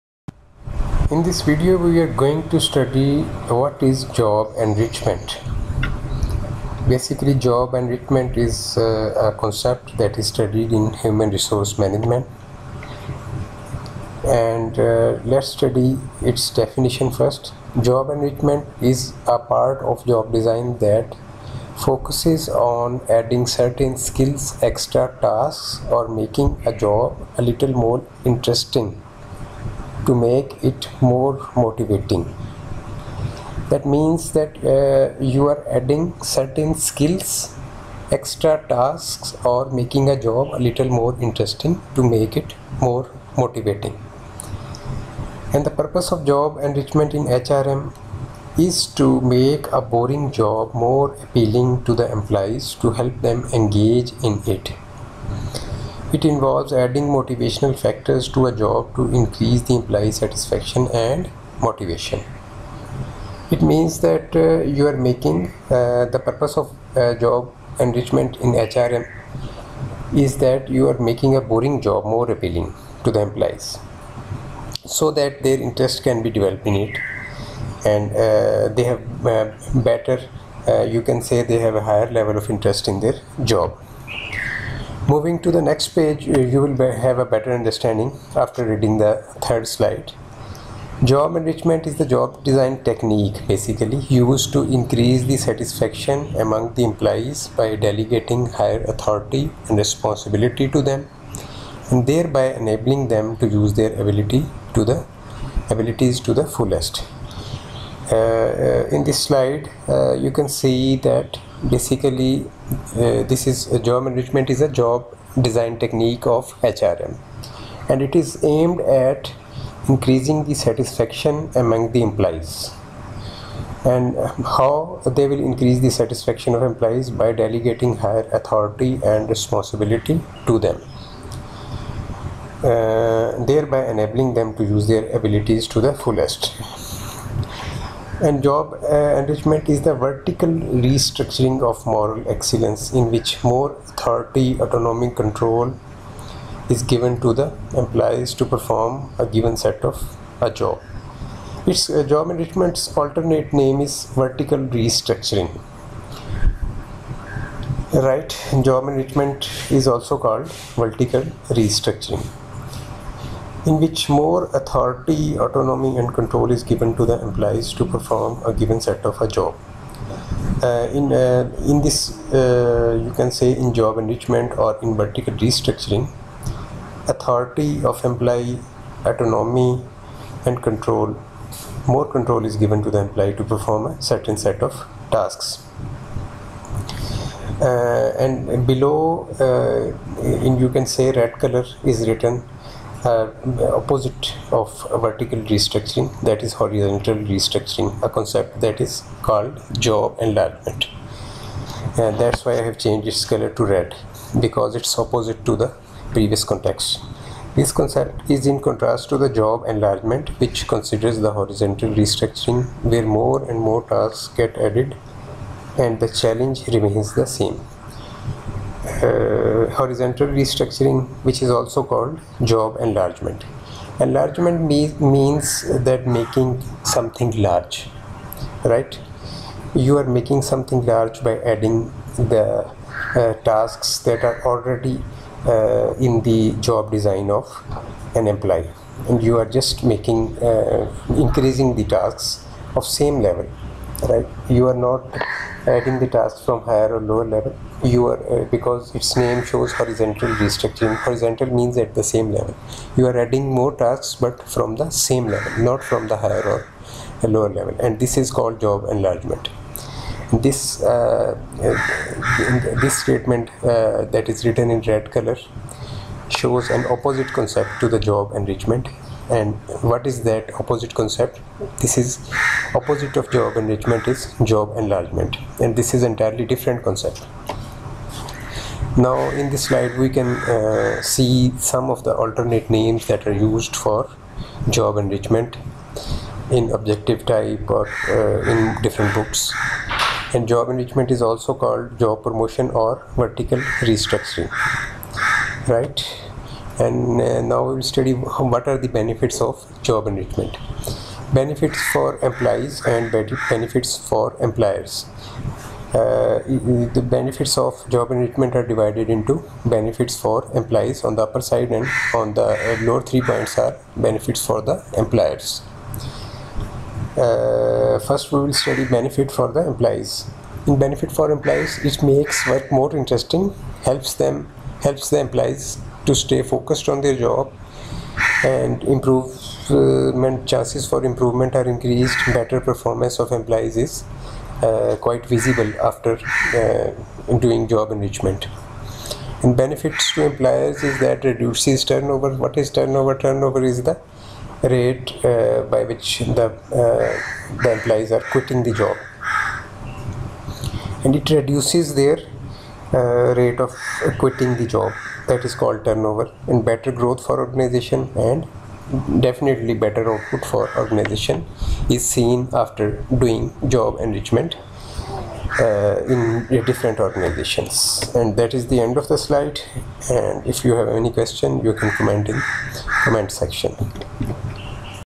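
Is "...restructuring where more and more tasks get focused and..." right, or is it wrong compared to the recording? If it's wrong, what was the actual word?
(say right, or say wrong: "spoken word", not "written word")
wrong: "added", not "focused".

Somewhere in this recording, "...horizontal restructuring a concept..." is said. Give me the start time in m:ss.
3:16.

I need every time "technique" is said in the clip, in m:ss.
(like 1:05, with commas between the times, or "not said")
1:32, 1:55.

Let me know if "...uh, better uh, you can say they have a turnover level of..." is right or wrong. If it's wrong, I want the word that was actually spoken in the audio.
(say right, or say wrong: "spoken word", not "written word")
wrong: "higher", not "turnover".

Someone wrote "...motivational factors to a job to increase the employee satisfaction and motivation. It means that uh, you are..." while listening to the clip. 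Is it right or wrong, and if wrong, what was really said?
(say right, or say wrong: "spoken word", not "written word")
right.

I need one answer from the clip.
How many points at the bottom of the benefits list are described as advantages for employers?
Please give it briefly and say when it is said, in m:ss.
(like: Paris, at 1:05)
3, at 5:13.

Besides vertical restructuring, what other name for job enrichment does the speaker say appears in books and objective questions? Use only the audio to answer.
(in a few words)
Job promotion.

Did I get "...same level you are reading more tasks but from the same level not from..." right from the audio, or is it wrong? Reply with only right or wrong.
wrong.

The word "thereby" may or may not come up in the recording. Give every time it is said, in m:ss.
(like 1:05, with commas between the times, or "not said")
1:42, 2:13.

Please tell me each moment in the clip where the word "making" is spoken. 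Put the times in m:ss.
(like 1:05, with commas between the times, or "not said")
0:26, 0:39, 1:04, 1:10, 3:46, 3:50, 3:59.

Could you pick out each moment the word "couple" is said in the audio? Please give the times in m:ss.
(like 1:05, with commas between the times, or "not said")
not said.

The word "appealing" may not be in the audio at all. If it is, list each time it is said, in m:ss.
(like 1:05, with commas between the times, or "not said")
0:51, 1:12.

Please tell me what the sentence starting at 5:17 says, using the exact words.
Uh, first we will study benefit for the employees.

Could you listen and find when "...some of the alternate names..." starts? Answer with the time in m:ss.
4:41.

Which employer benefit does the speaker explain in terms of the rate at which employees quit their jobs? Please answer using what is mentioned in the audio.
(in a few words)
Reduces turnover.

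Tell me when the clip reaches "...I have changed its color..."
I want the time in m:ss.
3:22.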